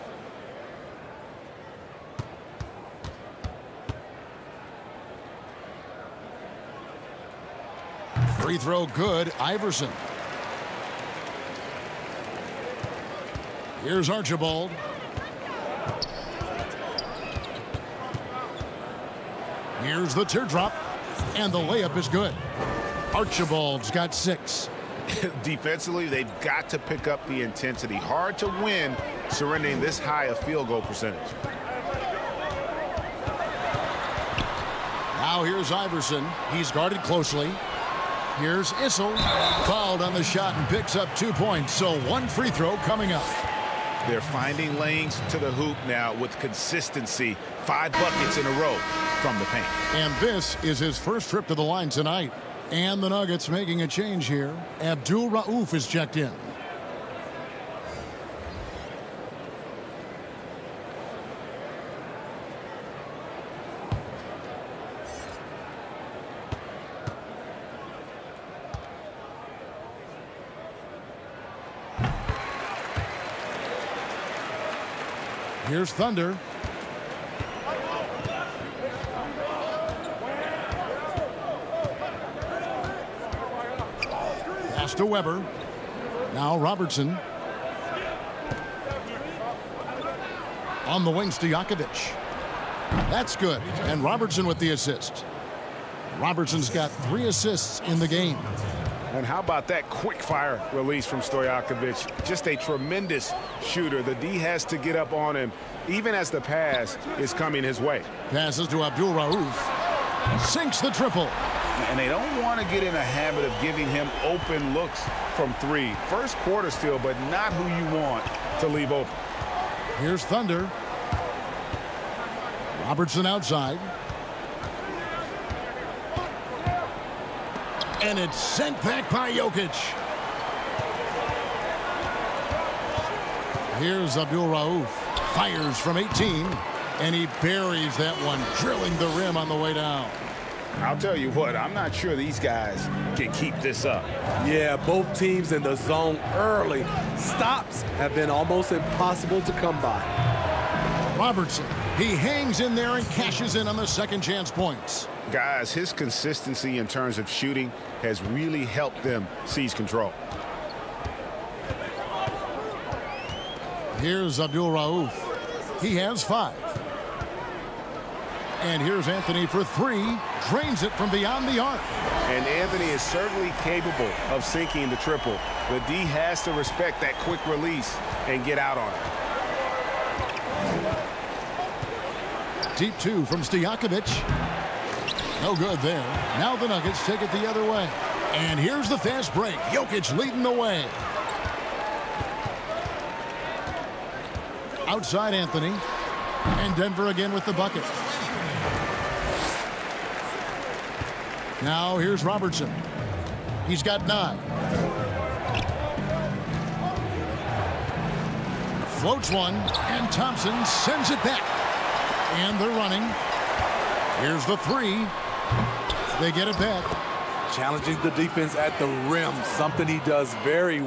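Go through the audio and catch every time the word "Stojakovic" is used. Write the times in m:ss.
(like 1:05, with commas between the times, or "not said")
1:41, 3:03.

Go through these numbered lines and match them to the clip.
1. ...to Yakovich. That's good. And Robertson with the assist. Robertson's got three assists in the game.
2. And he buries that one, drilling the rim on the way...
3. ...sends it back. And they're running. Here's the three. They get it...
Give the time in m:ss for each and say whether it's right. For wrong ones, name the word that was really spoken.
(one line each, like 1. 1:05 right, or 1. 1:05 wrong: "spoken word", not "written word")
1. 1:31 right
2. 2:16 right
3. 3:30 right.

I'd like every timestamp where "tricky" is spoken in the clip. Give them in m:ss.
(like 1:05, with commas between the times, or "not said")
not said.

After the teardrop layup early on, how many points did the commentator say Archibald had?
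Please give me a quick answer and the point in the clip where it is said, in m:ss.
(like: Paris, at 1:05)
6, at 0:24.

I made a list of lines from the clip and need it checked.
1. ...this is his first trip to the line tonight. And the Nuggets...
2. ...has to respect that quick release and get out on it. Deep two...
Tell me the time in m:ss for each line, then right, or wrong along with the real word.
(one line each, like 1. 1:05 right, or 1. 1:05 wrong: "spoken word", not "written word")
1. 0:50 right
2. 2:55 right.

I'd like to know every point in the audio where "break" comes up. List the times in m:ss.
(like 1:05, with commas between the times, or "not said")
3:09.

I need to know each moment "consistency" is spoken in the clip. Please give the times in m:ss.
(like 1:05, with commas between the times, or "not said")
0:46, 2:35.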